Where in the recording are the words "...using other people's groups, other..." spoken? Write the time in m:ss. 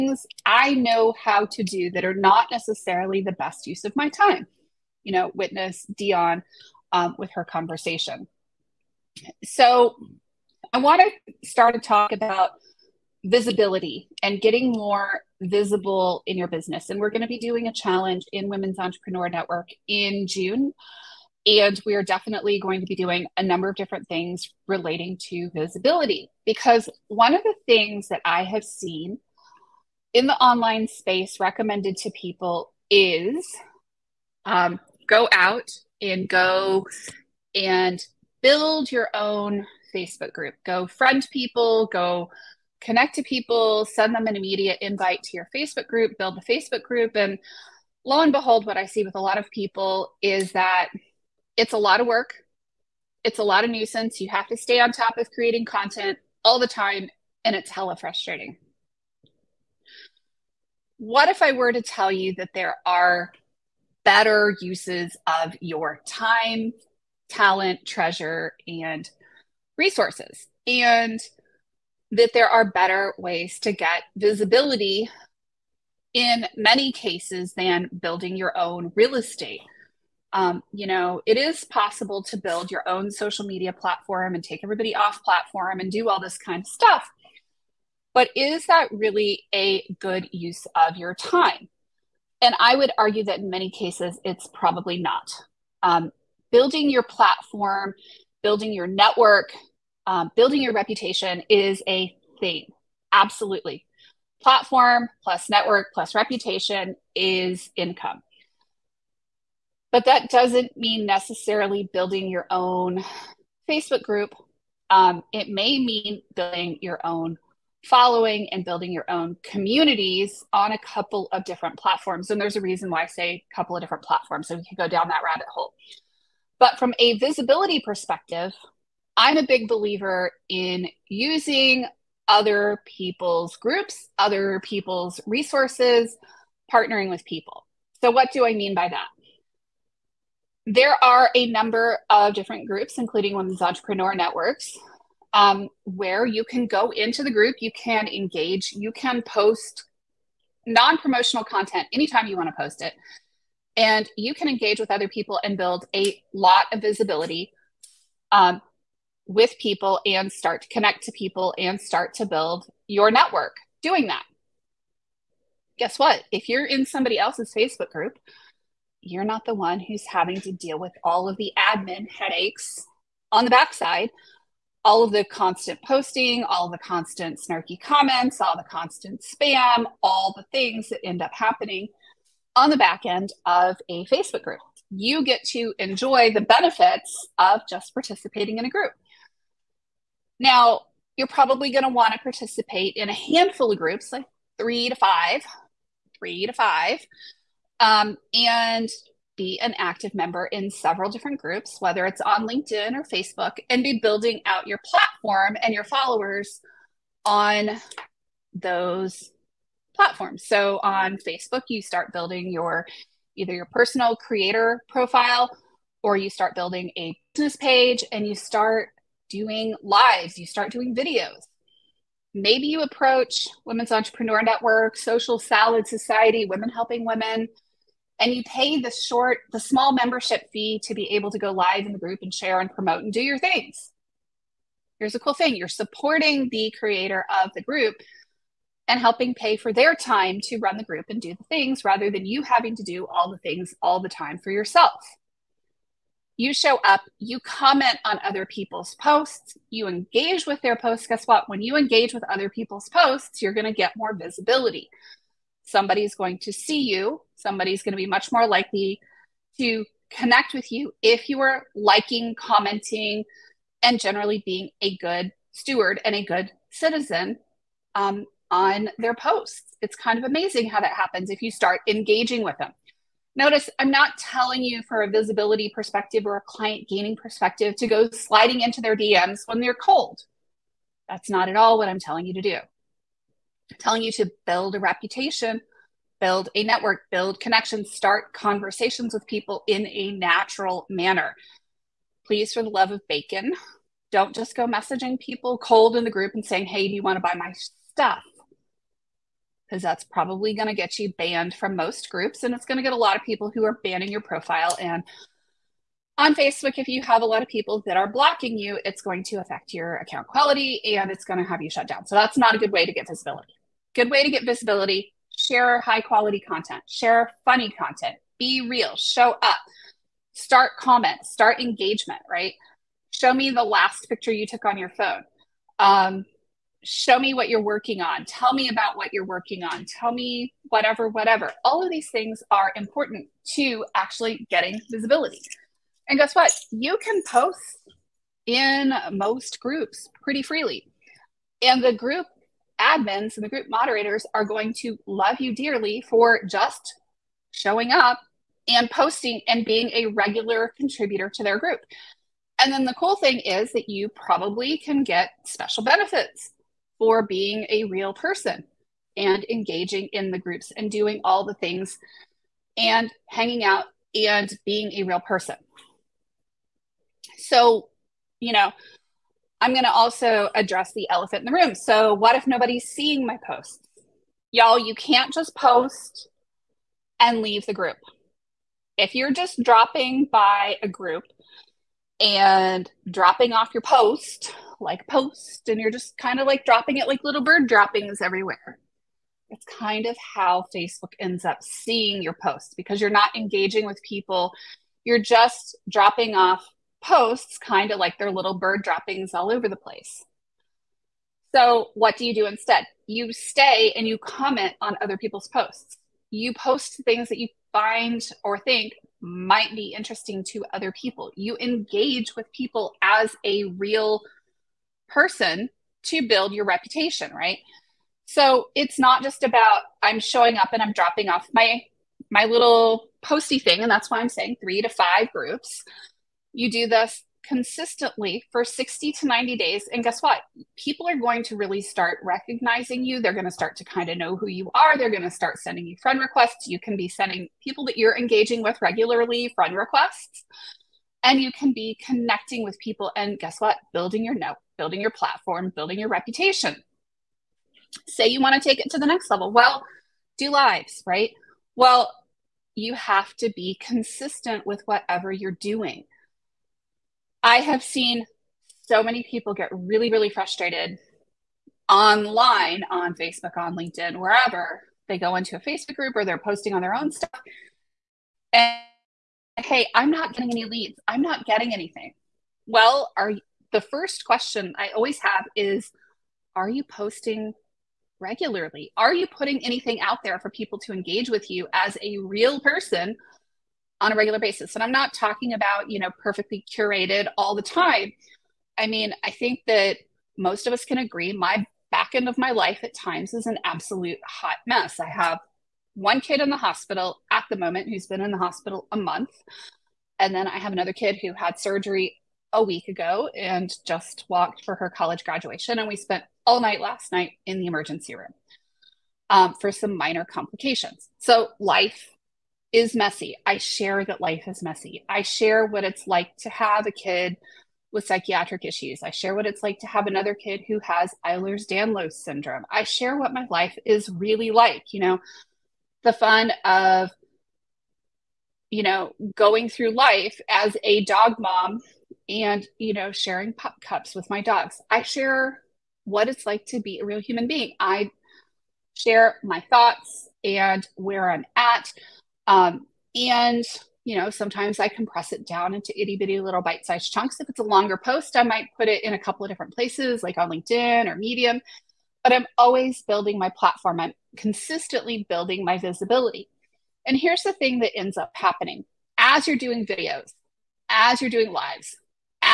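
2:11.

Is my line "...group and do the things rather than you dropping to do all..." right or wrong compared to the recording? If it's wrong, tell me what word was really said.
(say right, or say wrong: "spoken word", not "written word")
wrong: "having", not "dropping".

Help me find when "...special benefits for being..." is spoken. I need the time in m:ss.
5:55.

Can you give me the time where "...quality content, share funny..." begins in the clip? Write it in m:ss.
5:16.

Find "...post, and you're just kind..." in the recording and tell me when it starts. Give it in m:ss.
6:25.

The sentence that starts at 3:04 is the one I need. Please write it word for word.
You get to enjoy the benefits of just participating in a group.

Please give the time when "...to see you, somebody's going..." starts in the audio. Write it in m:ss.
4:16.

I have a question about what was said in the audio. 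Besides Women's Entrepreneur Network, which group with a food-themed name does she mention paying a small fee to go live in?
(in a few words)
Social Salad Society.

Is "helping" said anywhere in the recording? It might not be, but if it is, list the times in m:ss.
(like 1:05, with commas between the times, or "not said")
3:46, 3:59.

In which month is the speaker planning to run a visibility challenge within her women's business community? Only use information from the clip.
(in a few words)
June.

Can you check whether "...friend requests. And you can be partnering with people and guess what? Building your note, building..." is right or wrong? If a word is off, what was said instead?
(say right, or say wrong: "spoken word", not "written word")
wrong: "connecting", not "partnering".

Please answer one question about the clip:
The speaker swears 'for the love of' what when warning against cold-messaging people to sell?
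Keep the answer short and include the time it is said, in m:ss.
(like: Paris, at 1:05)
Bacon, at 4:53.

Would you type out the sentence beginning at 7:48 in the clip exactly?
And hey, I'm not getting any leads.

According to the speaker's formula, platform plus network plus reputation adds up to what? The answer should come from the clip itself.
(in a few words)
Income.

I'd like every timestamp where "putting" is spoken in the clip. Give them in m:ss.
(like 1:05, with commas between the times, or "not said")
7:59.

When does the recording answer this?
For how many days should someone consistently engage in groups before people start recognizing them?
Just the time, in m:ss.
7:08.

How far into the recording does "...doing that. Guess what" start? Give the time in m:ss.
2:43.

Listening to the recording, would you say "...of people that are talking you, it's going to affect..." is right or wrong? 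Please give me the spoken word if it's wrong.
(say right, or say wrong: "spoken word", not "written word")
wrong: "blocking", not "talking".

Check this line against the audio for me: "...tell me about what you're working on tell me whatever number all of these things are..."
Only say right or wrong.
wrong.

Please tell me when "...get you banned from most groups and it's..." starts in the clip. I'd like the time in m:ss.
5:00.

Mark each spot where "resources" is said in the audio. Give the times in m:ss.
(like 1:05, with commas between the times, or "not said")
1:09, 2:15.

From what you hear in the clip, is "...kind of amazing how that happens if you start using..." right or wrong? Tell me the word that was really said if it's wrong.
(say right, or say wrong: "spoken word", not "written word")
wrong: "engaging", not "using".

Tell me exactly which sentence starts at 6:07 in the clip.
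So, you know, I'm going to also address the elephant in the room.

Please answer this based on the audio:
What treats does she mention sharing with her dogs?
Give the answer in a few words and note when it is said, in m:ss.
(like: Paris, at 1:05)
Pup cups, at 8:53.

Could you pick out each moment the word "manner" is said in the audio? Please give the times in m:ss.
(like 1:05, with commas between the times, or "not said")
4:50.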